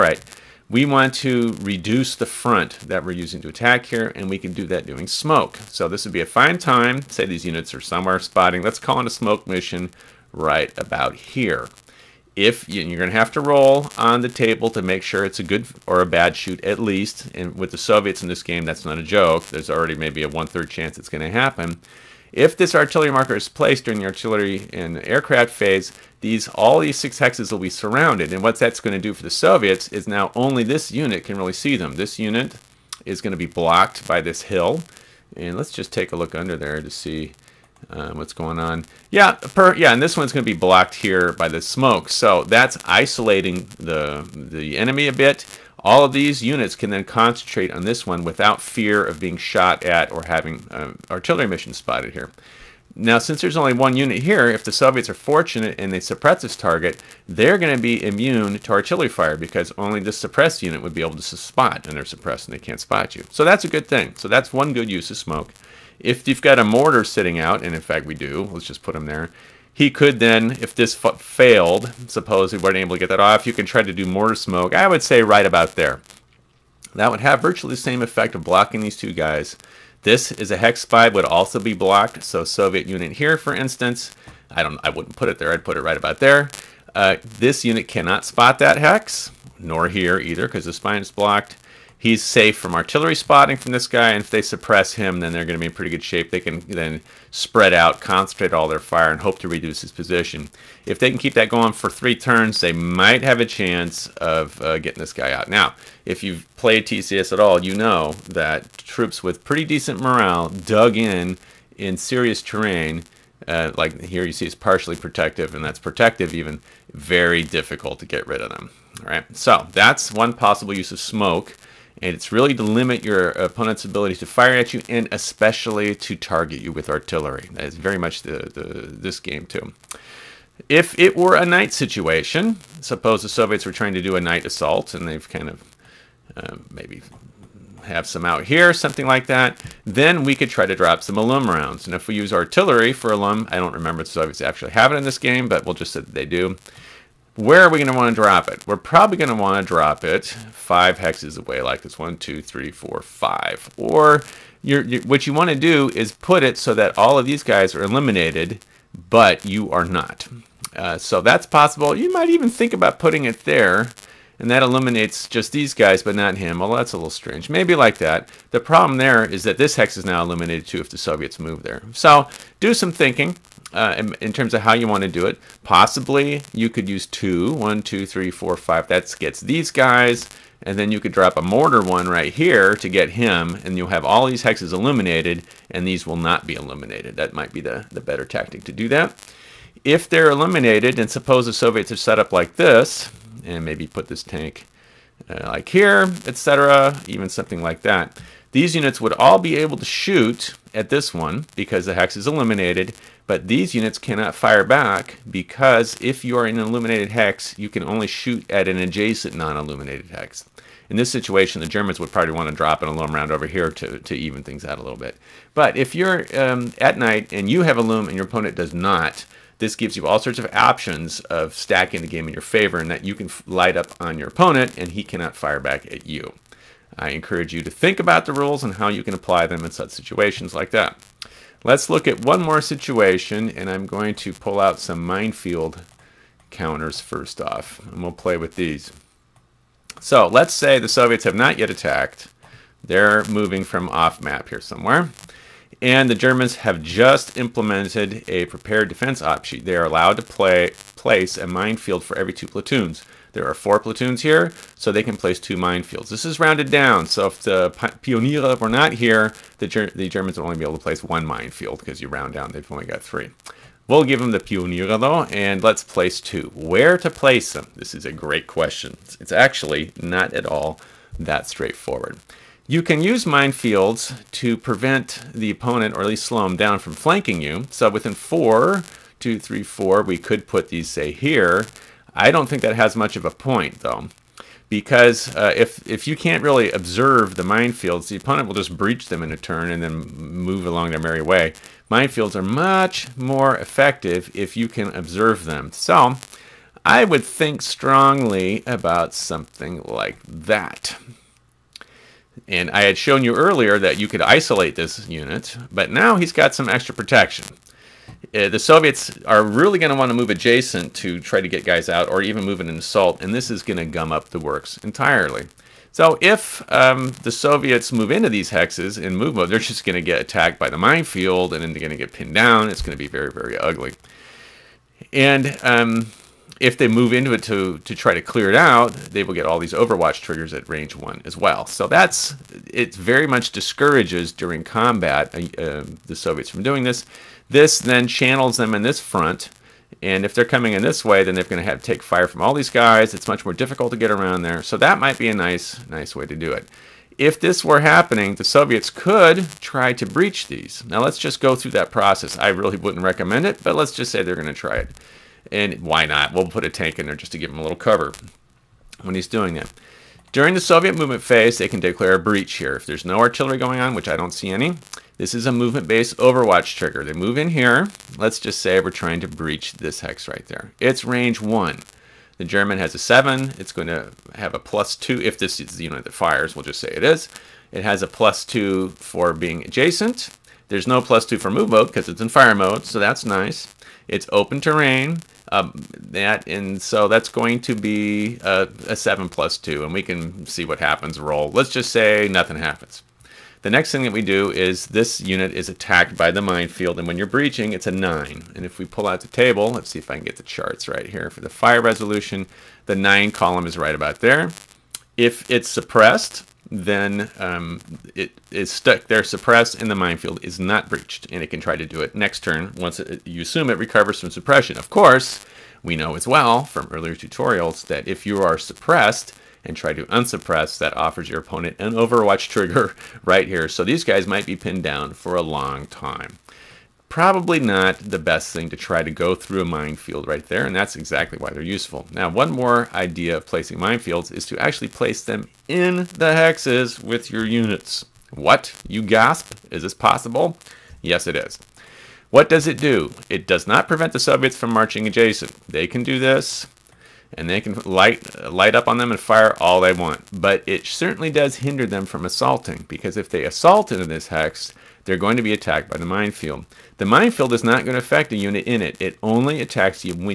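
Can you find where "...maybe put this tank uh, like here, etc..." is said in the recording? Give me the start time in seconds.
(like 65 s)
193 s.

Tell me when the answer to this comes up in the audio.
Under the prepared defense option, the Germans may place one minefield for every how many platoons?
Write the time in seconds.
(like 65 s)
252 s.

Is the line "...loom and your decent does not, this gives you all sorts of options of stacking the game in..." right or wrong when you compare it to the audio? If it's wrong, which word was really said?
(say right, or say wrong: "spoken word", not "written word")
wrong: "opponent", not "decent".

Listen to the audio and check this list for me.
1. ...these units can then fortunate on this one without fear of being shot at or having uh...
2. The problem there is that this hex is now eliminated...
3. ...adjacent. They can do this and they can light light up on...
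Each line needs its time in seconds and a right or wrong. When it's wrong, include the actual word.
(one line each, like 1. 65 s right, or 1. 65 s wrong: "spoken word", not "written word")
1. 46 s wrong: "concentrate", not "fortunate"
2. 168 s right
3. 445 s right.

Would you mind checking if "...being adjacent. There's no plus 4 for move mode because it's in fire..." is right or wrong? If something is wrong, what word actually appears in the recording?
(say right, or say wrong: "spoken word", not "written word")
wrong: "2", not "4".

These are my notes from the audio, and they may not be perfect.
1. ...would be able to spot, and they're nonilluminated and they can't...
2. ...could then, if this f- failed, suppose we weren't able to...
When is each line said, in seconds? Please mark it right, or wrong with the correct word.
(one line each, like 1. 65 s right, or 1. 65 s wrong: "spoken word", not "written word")
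1. 60 s wrong: "suppressed", not "nonilluminated"
2. 69 s right.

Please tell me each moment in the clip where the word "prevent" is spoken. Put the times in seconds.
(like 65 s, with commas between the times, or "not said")
274 s, 443 s.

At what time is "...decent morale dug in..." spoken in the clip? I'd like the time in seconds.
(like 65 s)
109 s.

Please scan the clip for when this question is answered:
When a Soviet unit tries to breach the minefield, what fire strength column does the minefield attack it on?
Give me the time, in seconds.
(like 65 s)
397 s.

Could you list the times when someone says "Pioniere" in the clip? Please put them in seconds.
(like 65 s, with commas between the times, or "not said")
257 s, 264 s.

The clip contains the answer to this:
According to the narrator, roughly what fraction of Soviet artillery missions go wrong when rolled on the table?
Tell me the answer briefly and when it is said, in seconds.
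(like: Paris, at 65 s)
one-third, at 20 s.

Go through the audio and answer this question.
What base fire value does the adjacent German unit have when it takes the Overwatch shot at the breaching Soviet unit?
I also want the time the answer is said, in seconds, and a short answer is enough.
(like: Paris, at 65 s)
7, at 372 s.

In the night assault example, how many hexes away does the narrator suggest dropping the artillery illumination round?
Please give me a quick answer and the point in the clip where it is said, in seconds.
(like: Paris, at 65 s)
5, at 150 s.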